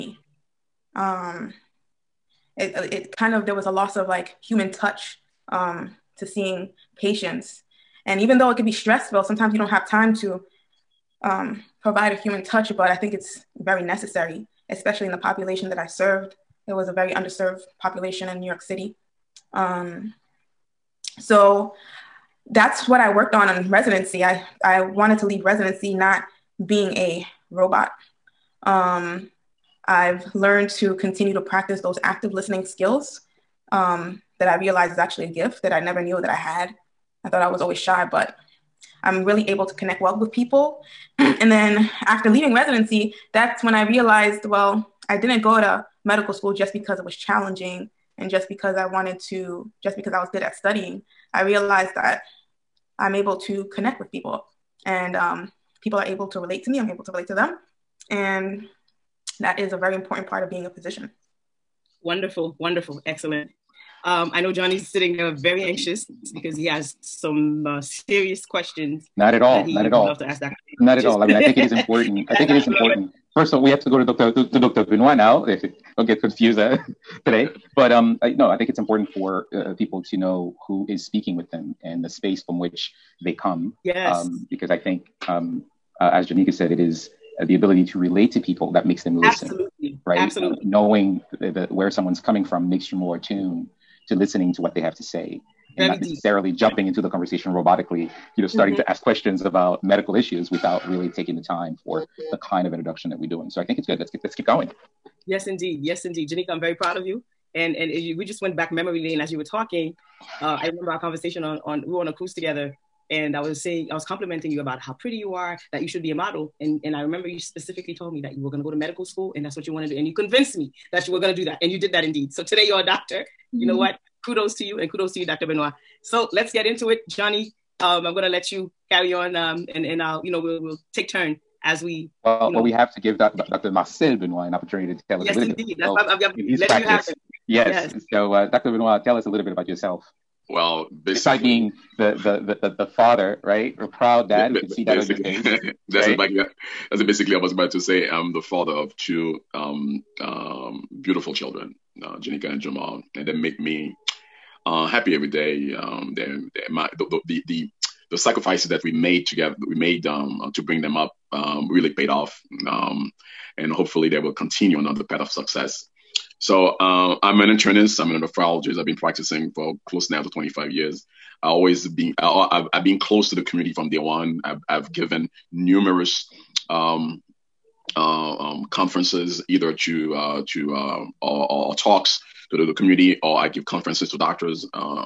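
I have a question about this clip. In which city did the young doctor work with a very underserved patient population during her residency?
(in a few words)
New York City.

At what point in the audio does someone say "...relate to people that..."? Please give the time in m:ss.
1:27.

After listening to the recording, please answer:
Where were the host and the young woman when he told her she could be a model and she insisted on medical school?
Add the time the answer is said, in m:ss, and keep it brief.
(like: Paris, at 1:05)
On a cruise, at 1:52.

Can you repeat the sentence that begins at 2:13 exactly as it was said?
Marcel Benoit an opportunity to tell us yes, a little indeed.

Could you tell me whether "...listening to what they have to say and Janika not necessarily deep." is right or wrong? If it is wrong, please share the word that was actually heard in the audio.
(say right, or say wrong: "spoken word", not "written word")
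wrong: "Very", not "Janika".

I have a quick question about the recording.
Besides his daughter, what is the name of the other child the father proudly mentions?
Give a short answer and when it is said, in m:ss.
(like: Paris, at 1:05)
Jamal, at 2:32.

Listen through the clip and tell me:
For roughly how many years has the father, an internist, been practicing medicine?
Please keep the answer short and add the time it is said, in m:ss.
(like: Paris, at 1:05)
25 years, at 2:50.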